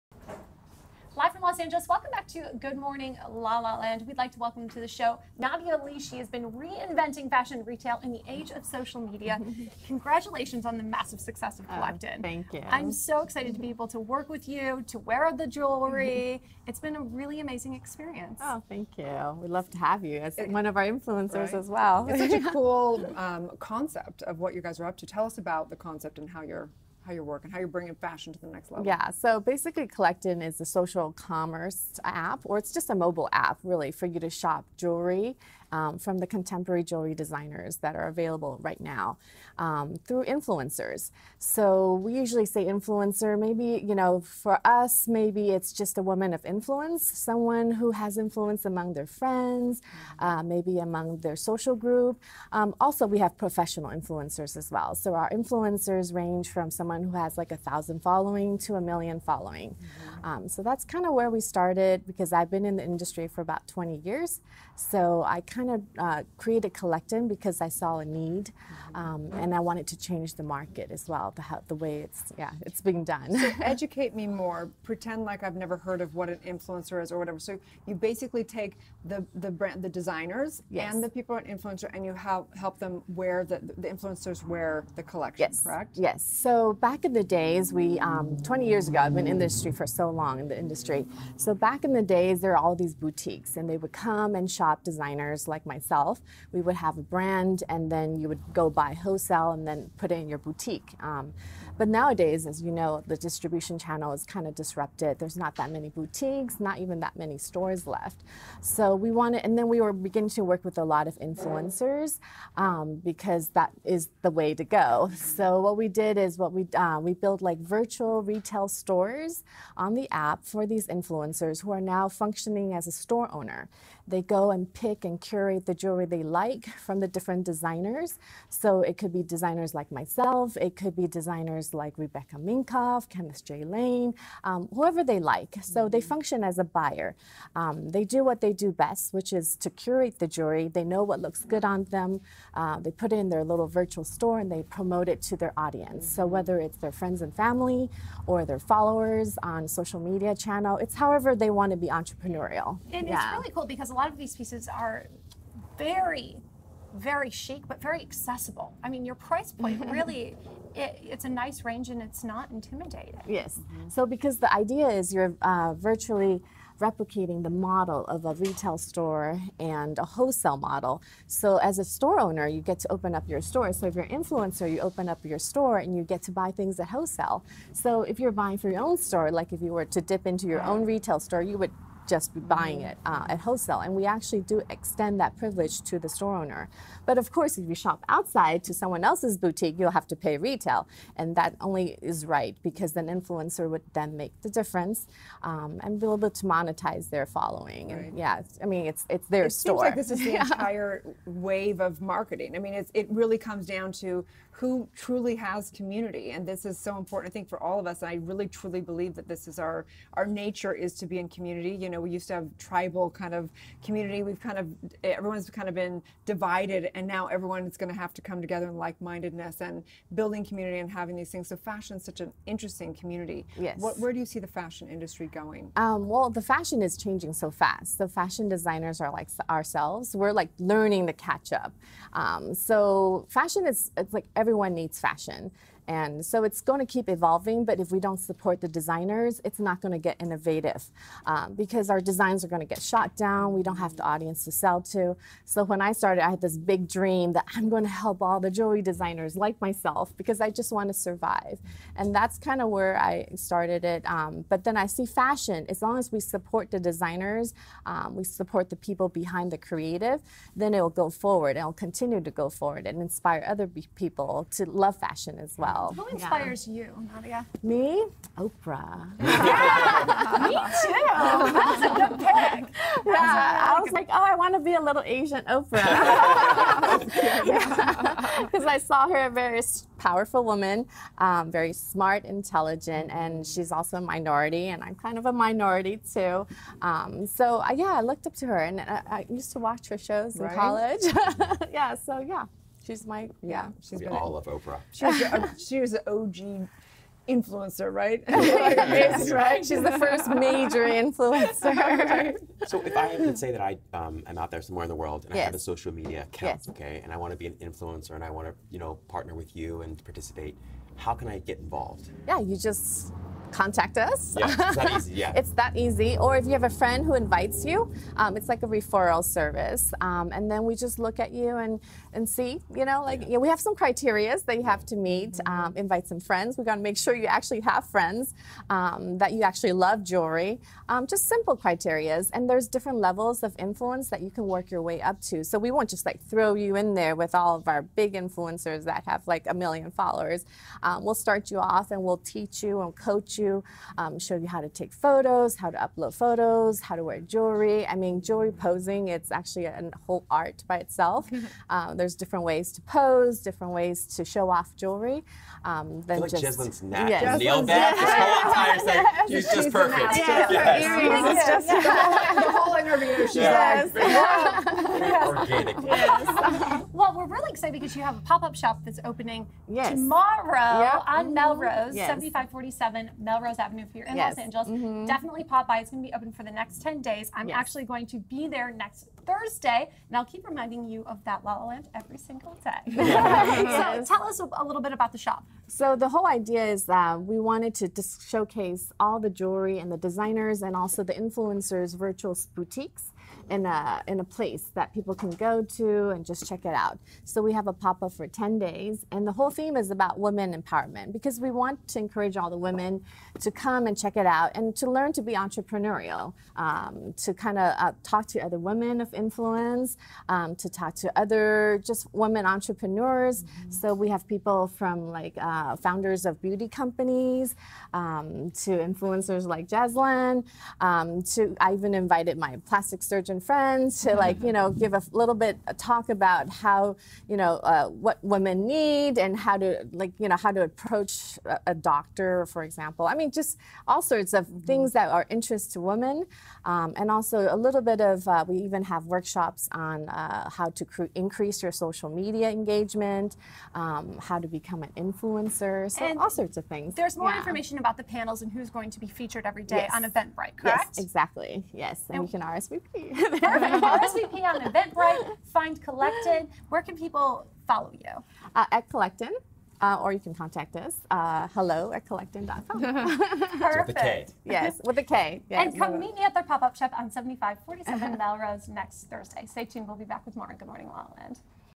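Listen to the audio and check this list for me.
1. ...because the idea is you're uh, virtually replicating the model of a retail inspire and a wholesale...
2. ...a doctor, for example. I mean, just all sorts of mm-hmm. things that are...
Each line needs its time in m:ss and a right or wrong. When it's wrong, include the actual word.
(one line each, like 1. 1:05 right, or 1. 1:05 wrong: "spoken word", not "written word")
1. 2:44 wrong: "store", not "inspire"
2. 7:11 right.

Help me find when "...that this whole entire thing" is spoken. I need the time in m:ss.
5:57.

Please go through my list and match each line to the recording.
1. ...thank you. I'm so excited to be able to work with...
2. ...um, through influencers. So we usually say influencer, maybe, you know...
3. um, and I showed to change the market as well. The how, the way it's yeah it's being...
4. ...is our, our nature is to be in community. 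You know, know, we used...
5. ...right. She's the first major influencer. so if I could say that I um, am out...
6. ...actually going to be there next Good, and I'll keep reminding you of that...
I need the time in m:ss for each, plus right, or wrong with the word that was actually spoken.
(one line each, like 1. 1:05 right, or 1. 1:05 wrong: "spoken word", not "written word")
1. 0:12 right
2. 0:39 right
3. 1:08 wrong: "wanted", not "showed"
4. 3:29 right
5. 4:59 right
6. 6:17 wrong: "Thursday", not "Good".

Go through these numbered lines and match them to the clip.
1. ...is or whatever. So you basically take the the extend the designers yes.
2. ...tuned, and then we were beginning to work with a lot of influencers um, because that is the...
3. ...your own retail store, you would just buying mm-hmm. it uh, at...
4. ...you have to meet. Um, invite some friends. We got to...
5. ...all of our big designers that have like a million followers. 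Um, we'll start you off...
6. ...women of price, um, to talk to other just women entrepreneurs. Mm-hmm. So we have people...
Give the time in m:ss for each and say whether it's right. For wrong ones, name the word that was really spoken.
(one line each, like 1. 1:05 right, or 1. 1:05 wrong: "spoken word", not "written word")
1. 1:17 wrong: "brand", not "extend"
2. 1:49 wrong: "wanted", not "tuned"
3. 3:00 right
4. 5:24 right
5. 5:37 wrong: "influencers", not "designers"
6. 6:48 wrong: "influence", not "price".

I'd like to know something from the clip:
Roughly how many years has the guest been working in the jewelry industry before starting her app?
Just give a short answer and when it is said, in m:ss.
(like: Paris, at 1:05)
20 years, at 1:03.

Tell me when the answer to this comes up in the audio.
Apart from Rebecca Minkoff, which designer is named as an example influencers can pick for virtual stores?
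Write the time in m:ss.
2:13.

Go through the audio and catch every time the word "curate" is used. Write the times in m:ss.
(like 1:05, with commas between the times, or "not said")
2:05, 2:19.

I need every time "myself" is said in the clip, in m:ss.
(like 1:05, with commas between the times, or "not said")
1:35, 2:09, 4:09.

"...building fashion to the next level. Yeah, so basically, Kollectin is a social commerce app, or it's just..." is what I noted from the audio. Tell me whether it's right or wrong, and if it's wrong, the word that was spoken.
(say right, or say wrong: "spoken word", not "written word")
wrong: "bringing", not "building".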